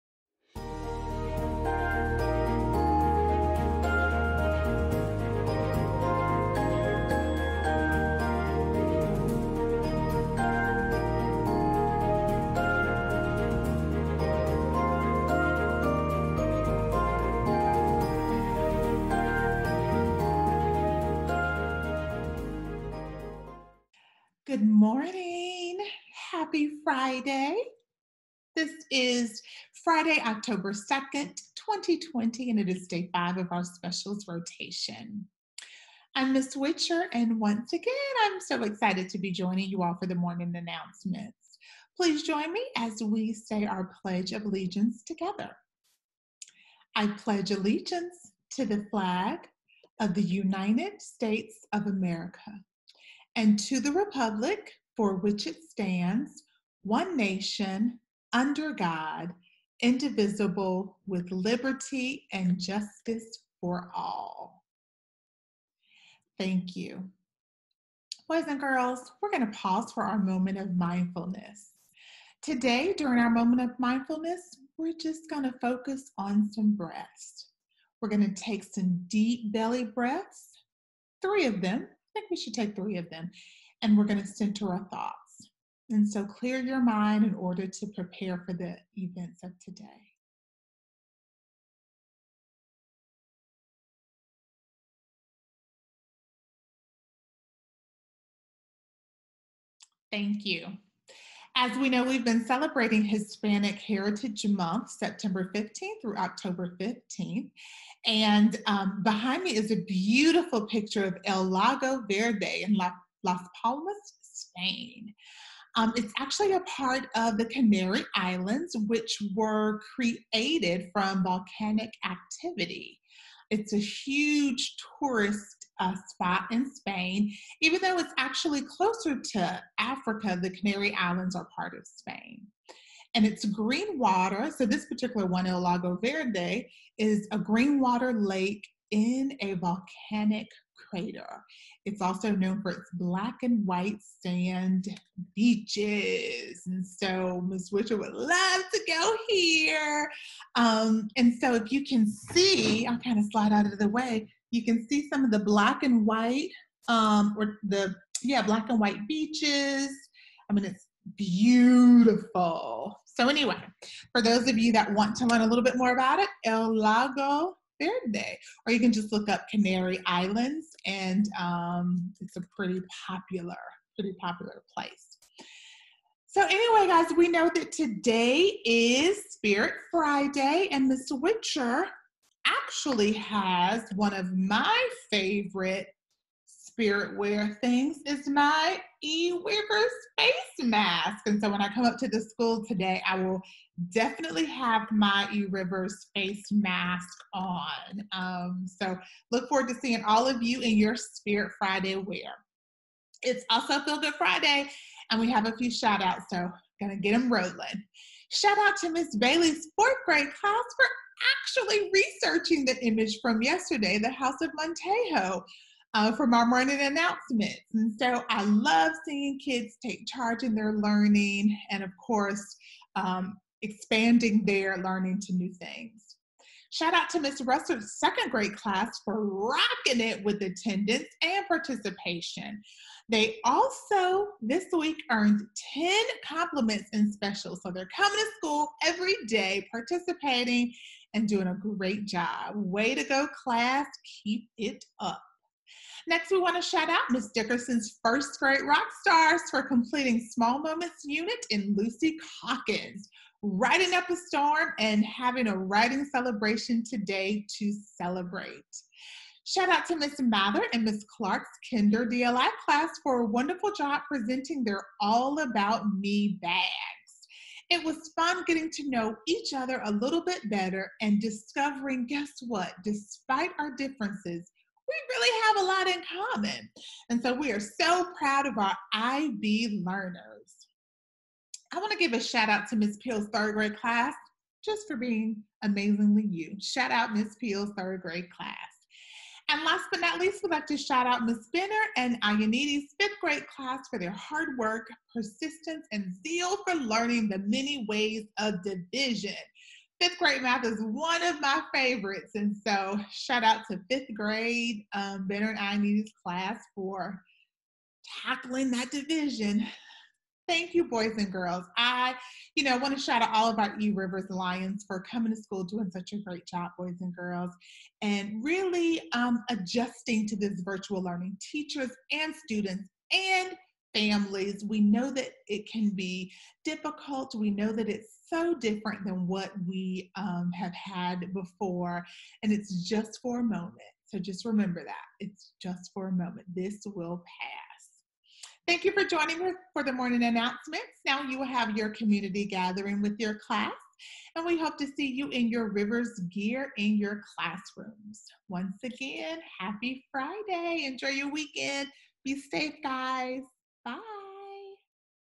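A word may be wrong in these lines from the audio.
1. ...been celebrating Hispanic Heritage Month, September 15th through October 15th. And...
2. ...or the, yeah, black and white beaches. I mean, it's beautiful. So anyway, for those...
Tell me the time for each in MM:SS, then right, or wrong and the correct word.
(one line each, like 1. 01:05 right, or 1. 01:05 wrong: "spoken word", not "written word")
1. 01:42 right
2. 02:37 right.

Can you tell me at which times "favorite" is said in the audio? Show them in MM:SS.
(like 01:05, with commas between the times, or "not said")
03:05, 05:01.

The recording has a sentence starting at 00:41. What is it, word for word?
Please join me as we say our Pledge of Allegiance together.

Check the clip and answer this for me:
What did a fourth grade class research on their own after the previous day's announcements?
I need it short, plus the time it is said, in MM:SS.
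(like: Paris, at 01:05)
House of Montejo, at 03:34.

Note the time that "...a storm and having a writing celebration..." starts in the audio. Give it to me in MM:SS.
04:14.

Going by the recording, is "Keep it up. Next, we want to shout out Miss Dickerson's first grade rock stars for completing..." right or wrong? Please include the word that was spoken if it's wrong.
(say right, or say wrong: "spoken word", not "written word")
right.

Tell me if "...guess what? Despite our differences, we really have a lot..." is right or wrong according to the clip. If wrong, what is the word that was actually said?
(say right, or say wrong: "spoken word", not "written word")
right.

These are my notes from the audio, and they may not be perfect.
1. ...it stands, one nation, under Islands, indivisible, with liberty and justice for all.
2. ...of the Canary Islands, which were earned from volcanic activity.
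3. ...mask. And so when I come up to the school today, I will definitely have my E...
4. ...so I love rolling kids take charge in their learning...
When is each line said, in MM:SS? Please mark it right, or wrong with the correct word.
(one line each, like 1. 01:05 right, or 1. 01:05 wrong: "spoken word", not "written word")
1. 00:55 wrong: "God", not "Islands"
2. 01:57 wrong: "created", not "earned"
3. 03:10 right
4. 03:37 wrong: "seeing", not "rolling".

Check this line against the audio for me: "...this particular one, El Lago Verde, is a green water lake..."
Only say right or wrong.
right.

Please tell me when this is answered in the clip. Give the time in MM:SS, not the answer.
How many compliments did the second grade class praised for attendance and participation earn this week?
03:55.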